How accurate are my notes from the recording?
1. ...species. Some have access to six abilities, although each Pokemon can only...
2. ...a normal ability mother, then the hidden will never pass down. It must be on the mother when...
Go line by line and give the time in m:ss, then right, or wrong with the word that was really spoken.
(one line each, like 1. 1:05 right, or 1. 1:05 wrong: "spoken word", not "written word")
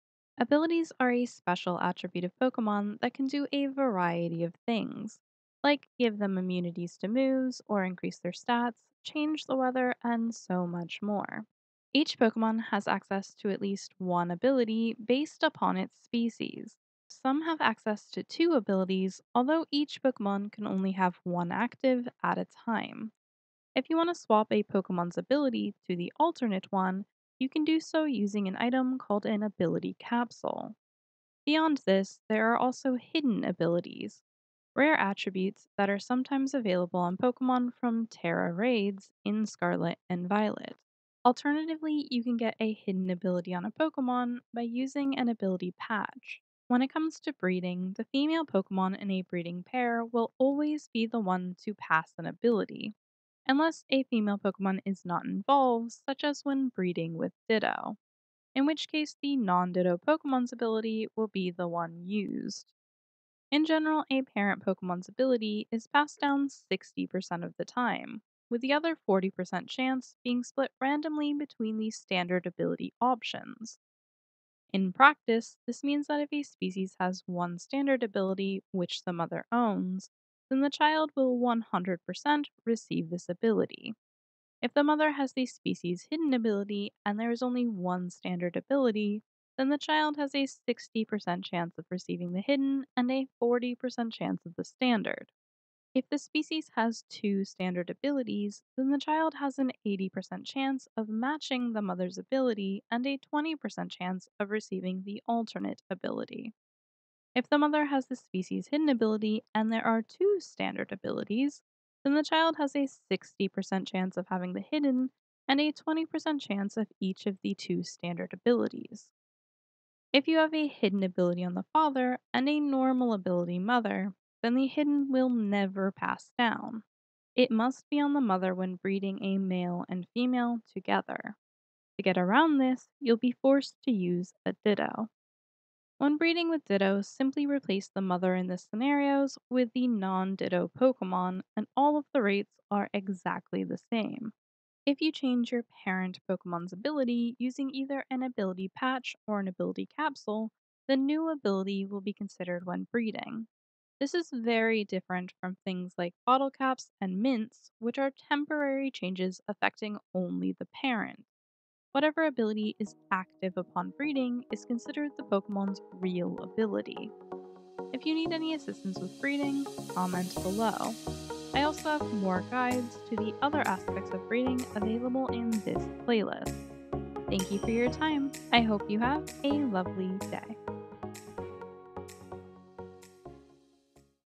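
1. 0:16 wrong: "two", not "six"
2. 2:02 right.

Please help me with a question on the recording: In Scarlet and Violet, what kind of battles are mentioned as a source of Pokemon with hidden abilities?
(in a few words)
Tera raids.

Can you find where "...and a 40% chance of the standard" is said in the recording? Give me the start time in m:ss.
1:32.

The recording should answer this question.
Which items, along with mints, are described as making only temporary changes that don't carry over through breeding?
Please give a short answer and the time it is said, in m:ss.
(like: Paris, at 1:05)
bottle caps, at 2:36.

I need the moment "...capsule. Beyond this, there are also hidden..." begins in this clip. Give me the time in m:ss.
0:29.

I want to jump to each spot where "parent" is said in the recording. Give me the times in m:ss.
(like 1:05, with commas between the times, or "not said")
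1:04, 2:25, 2:40.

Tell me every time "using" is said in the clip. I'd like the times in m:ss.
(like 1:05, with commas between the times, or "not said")
0:28, 0:44, 2:27.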